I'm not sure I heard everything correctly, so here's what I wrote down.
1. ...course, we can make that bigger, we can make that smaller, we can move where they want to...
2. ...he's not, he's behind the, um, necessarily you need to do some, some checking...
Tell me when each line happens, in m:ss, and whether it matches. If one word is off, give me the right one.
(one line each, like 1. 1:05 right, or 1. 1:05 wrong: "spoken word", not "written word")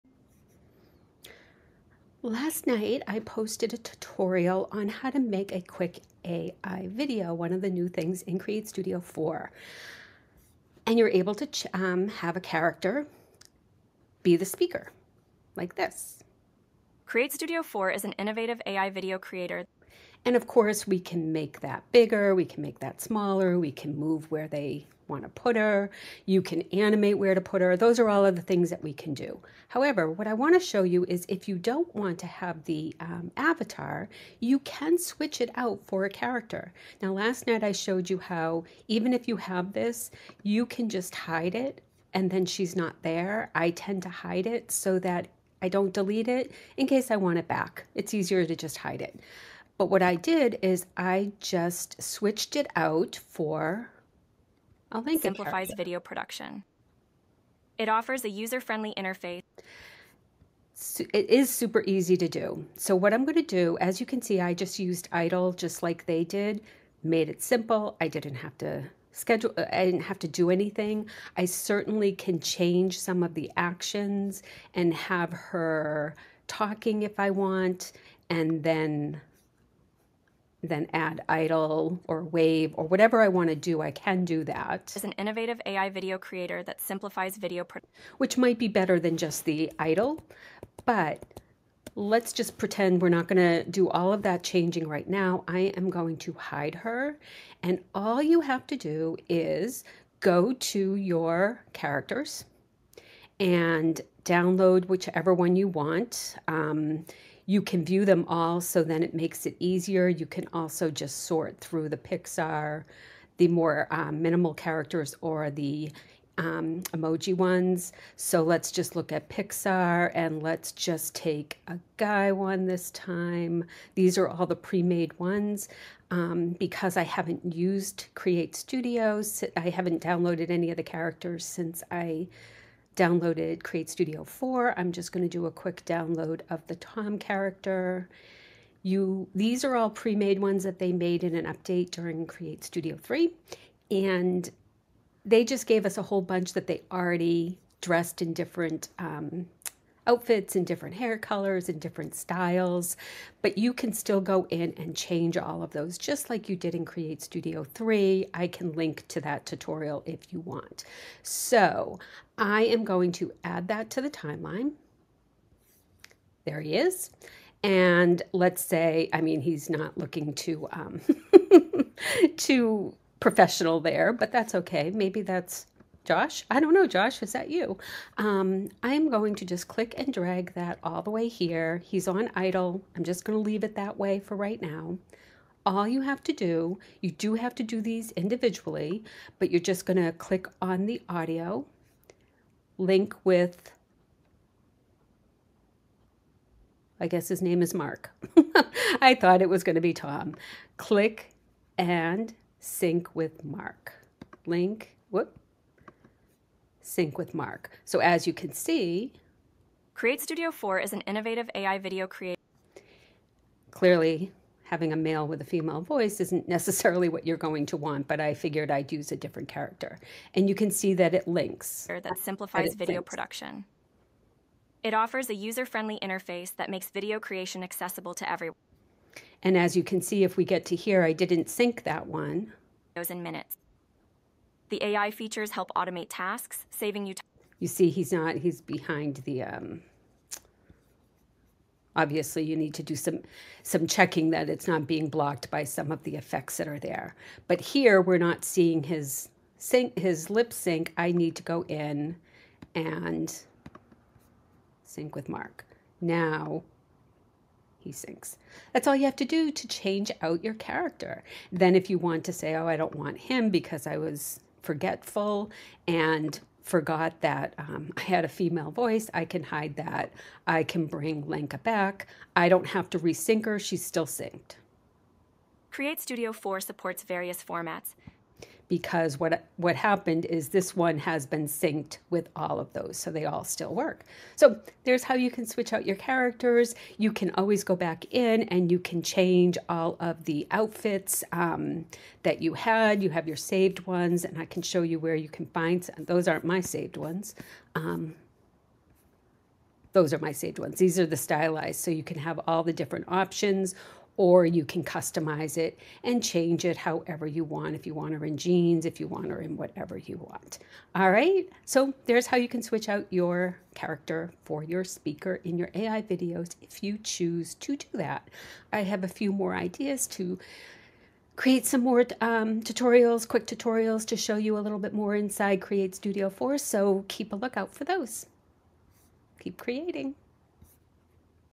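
1. 0:20 right
2. 3:57 wrong: "obviously", not "necessarily".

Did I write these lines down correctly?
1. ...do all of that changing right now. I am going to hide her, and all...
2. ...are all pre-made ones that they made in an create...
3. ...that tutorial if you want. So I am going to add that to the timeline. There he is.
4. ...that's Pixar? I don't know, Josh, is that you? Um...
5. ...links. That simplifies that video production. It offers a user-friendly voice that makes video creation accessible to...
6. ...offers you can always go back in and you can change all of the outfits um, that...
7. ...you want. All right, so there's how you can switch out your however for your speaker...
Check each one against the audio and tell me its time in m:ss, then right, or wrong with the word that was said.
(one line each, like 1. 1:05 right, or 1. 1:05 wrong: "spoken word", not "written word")
1. 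1:33 right
2. 2:19 wrong: "update", not "create"
3. 2:39 right
4. 2:55 wrong: "Josh", not "Pixar"
5. 3:41 wrong: "interface", not "voice"
6. 4:45 wrong: "characters", not "offers"
7. 5:09 wrong: "character", not "however".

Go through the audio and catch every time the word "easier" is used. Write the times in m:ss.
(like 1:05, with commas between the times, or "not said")
0:48, 1:49.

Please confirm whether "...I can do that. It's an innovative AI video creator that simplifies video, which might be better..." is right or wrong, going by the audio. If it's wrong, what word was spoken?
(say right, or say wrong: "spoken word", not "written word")
right.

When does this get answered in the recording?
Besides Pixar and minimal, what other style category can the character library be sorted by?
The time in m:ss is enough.
1:56.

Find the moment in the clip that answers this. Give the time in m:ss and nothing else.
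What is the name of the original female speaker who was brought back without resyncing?
4:31.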